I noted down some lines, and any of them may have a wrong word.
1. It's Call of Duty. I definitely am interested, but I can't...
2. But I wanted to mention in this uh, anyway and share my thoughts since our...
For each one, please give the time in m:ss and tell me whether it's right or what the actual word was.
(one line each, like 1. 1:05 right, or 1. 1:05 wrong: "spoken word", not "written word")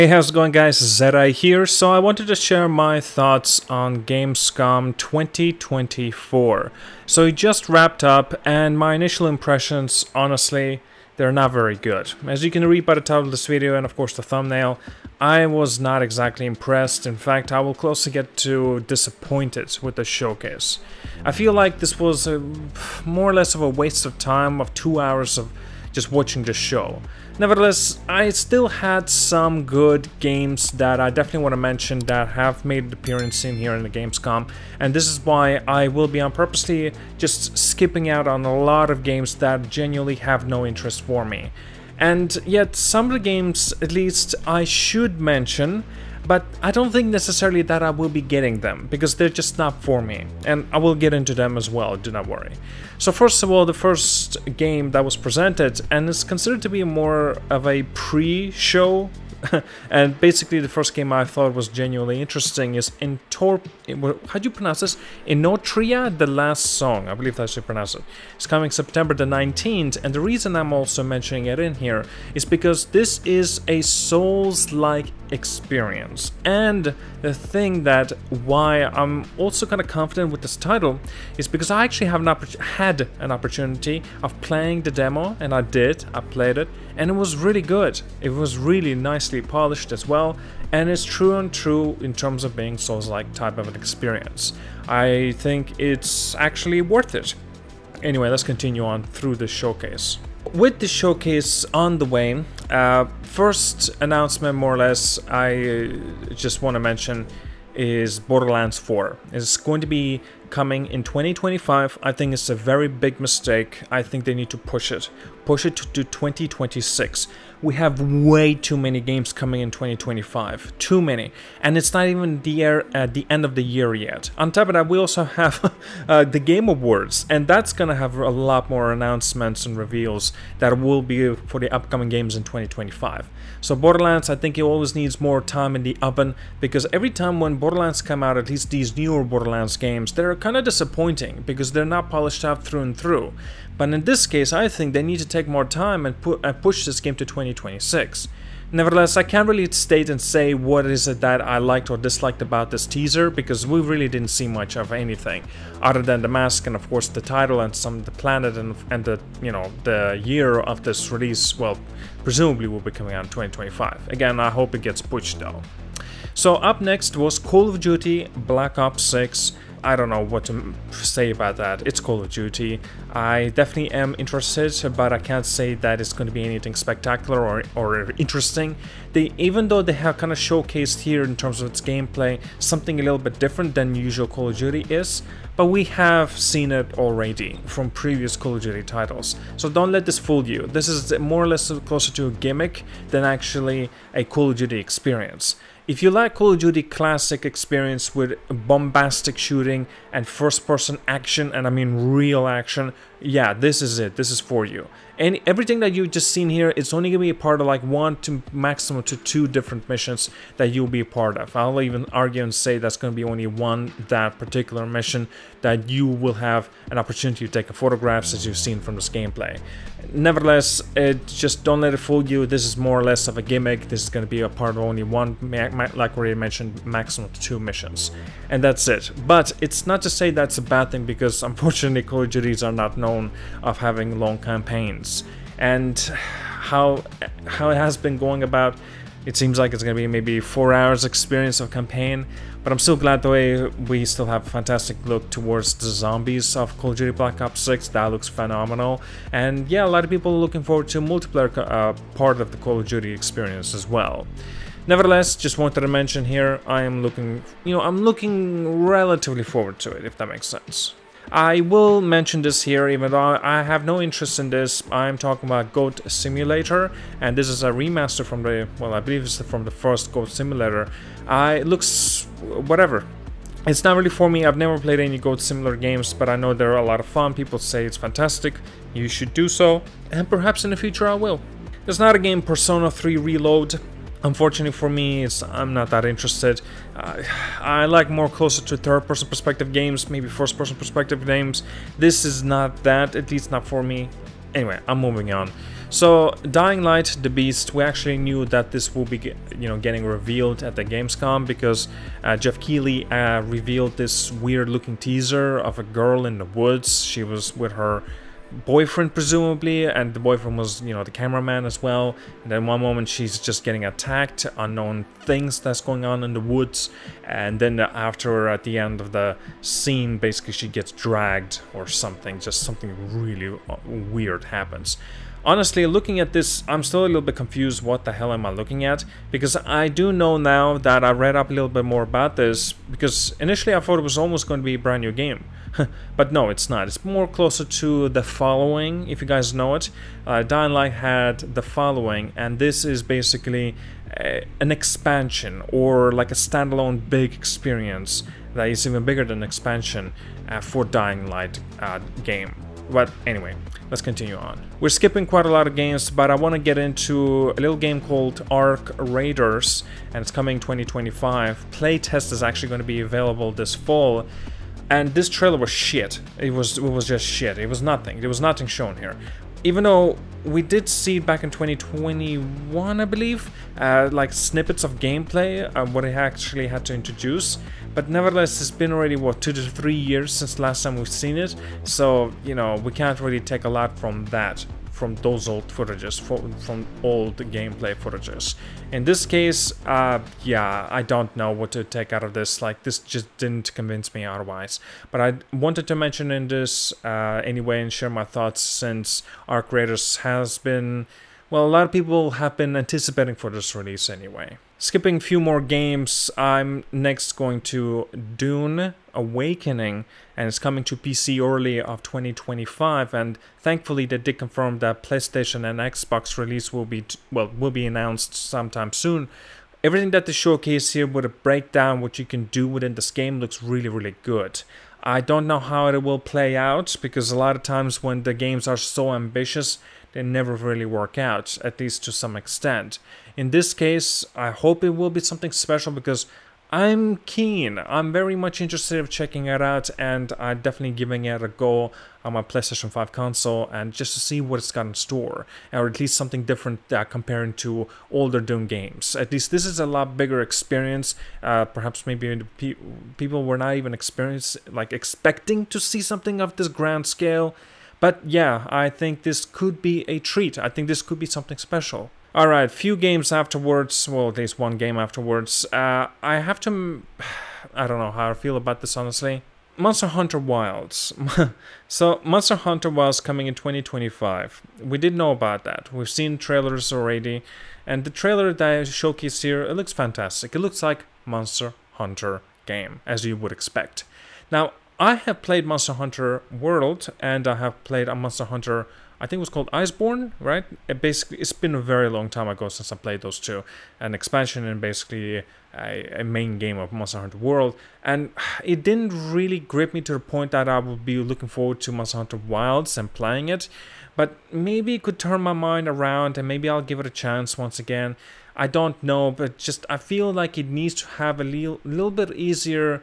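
1. 2:51 right
2. 6:35 right.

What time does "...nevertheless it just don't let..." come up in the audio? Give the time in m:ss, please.
3:40.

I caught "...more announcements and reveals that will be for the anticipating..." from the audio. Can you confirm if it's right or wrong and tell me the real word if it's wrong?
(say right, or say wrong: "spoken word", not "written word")
wrong: "upcoming", not "anticipating".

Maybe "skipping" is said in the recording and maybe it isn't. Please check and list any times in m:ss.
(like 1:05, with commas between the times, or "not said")
0:37, 5:54, 6:44.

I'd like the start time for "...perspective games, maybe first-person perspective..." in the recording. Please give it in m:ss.
4:49.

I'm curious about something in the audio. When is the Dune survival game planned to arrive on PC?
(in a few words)
early 2025.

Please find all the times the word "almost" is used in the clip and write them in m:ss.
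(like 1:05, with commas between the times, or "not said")
5:34.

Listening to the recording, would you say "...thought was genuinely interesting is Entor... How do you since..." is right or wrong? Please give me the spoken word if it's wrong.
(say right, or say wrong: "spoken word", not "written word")
wrong: "pronounce", not "since".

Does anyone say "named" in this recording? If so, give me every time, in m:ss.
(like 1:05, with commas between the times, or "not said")
not said.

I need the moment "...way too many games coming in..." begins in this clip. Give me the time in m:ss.
1:58.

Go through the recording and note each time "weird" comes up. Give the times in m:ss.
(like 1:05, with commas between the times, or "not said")
5:04, 5:23.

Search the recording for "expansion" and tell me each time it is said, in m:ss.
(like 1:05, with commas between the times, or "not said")
5:44, 5:49, 8:14.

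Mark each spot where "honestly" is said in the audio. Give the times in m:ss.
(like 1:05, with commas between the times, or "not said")
0:10, 5:25, 7:48.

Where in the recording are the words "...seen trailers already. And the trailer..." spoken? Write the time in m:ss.
7:56.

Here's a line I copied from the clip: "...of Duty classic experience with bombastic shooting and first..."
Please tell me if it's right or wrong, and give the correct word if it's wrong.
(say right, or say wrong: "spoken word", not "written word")
right.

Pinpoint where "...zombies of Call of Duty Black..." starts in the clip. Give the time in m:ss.
4:05.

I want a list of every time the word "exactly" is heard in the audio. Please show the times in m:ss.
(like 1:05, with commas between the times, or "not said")
0:16.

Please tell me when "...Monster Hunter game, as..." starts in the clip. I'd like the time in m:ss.
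8:01.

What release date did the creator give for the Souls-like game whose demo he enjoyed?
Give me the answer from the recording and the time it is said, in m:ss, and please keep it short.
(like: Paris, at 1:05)
September 19th, at 1:08.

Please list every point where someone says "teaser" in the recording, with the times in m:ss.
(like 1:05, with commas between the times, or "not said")
2:32, 5:04.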